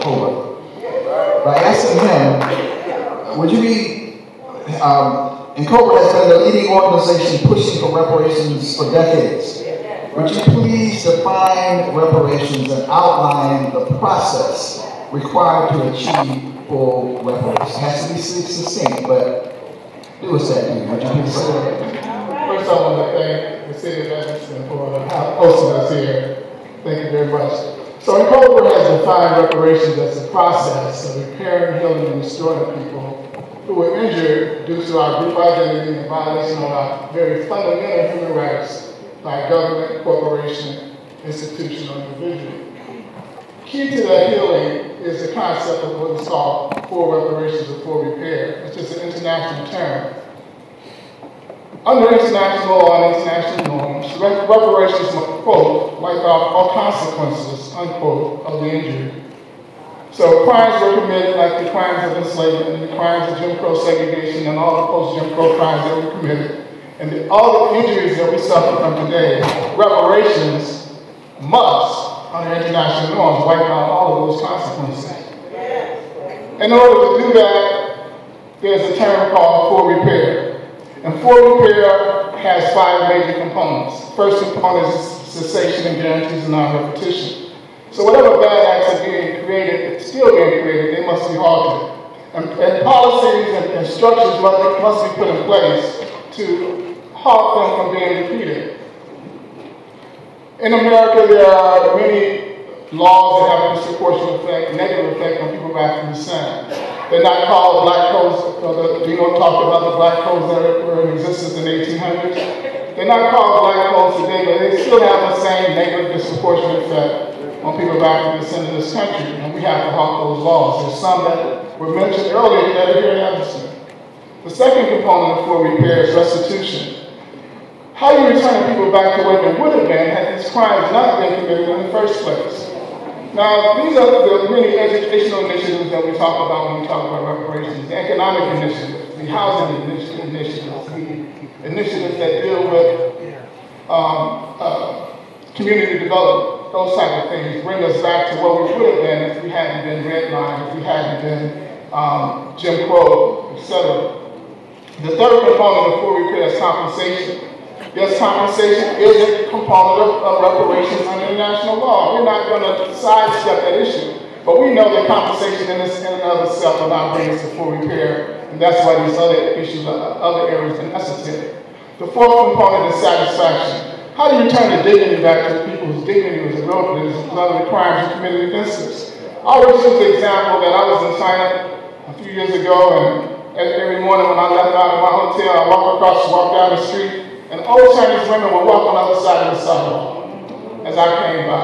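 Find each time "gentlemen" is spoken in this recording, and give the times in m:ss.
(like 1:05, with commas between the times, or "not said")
not said.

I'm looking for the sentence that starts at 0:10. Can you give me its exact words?
Would you please define reparations and outline the process required to achieve for weapons.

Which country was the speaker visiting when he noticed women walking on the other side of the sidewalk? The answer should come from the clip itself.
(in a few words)
China.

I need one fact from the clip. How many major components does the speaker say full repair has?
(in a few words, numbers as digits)
5.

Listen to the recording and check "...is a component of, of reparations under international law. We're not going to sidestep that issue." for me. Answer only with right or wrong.
right.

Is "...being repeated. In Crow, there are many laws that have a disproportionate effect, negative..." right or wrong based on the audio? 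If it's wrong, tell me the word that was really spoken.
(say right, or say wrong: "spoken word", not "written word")
wrong: "America", not "Crow".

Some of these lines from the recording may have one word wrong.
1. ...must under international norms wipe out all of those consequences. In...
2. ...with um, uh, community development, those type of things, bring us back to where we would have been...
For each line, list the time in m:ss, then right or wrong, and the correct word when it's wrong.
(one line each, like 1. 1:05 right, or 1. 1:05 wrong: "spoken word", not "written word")
1. 1:11 right
2. 2:22 right.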